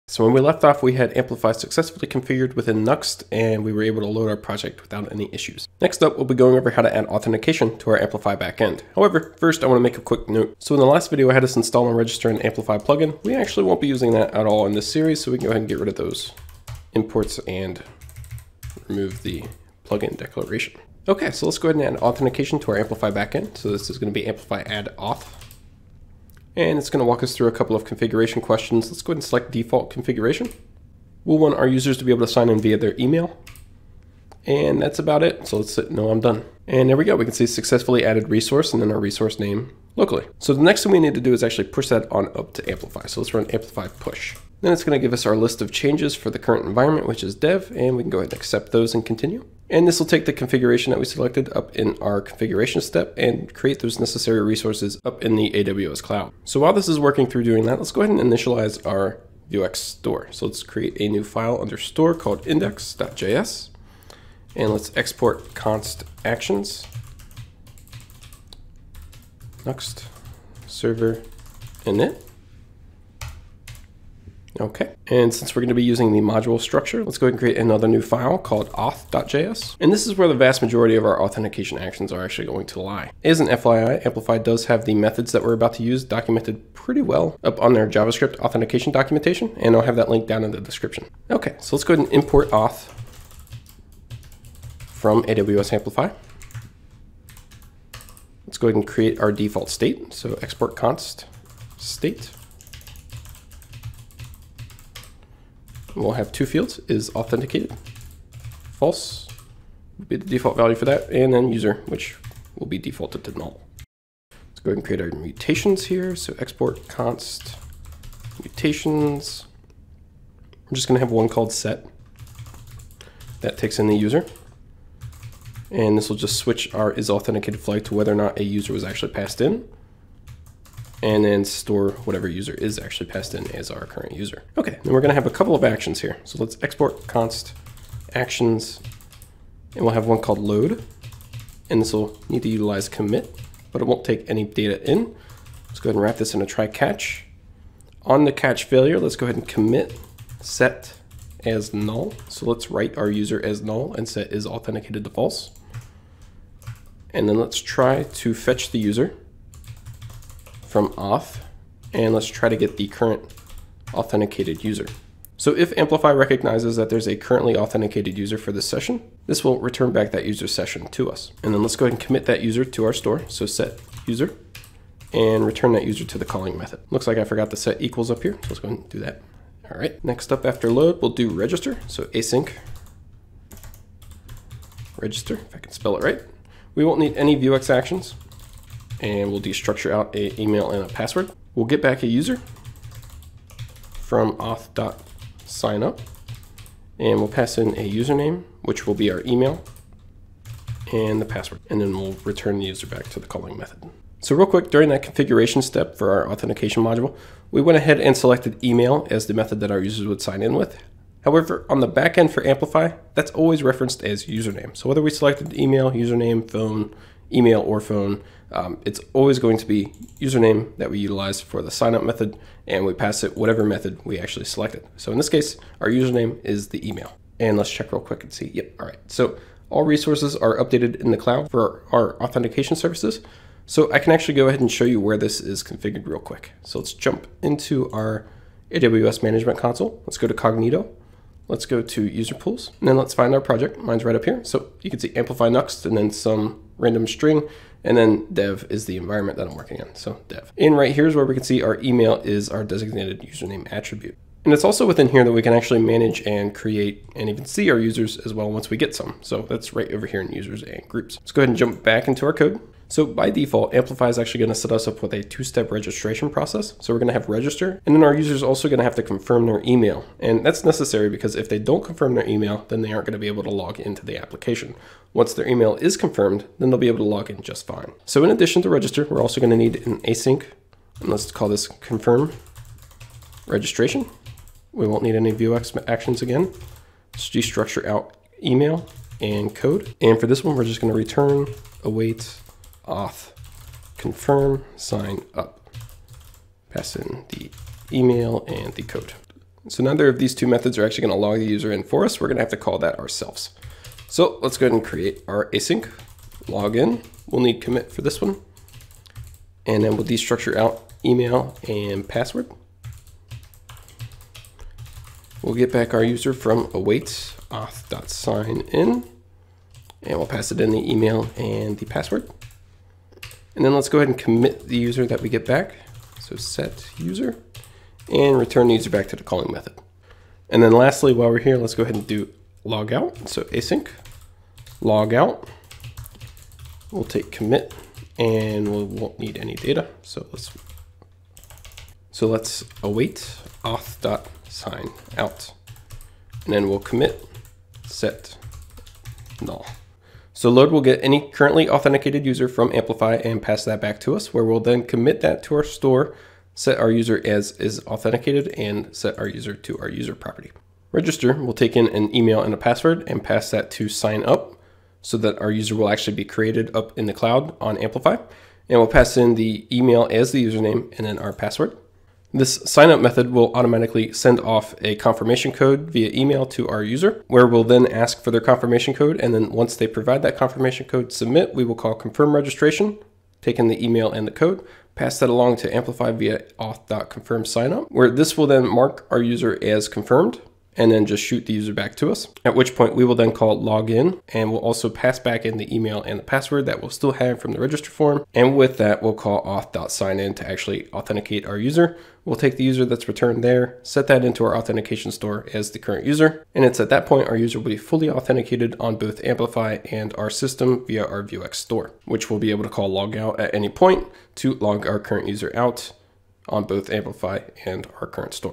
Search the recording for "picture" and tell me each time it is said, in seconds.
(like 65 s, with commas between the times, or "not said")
not said.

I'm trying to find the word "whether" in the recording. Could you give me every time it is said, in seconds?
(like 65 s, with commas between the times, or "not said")
127 s, 214 s.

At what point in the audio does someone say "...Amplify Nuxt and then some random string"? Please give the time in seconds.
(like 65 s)
245 s.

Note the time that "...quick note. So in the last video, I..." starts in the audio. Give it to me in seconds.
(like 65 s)
10 s.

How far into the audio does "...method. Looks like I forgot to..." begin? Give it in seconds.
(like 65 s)
176 s.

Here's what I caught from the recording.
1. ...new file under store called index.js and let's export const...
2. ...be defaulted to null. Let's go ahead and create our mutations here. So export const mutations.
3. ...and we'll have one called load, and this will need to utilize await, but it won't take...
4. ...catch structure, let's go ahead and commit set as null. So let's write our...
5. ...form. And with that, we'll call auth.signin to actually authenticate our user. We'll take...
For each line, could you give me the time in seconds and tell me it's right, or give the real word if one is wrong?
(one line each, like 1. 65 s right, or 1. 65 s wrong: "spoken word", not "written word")
1. 61 s right
2. 112 s right
3. 139 s wrong: "commit", not "await"
4. 148 s wrong: "failure", not "structure"
5. 397 s right.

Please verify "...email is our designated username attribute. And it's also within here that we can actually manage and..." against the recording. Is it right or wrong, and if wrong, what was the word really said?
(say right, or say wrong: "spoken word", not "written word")
right.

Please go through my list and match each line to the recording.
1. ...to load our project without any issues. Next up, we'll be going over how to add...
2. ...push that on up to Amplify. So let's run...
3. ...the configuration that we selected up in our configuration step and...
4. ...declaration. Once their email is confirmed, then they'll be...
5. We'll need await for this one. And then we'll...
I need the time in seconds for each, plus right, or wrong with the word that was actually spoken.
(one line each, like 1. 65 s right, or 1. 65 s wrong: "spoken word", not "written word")
1. 4 s right
2. 41 s right
3. 50 s right
4. 274 s wrong: "application", not "declaration"
5. 307 s wrong: "commit", not "await".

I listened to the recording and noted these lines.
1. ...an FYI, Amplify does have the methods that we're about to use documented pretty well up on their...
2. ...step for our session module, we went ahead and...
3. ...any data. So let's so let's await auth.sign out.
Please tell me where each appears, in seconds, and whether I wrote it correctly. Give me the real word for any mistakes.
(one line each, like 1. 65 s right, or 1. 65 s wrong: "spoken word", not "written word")
1. 83 s right
2. 205 s wrong: "authentication", not "session"
3. 339 s right.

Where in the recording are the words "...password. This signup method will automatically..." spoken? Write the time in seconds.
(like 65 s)
371 s.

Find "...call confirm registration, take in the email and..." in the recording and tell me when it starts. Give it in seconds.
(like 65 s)
381 s.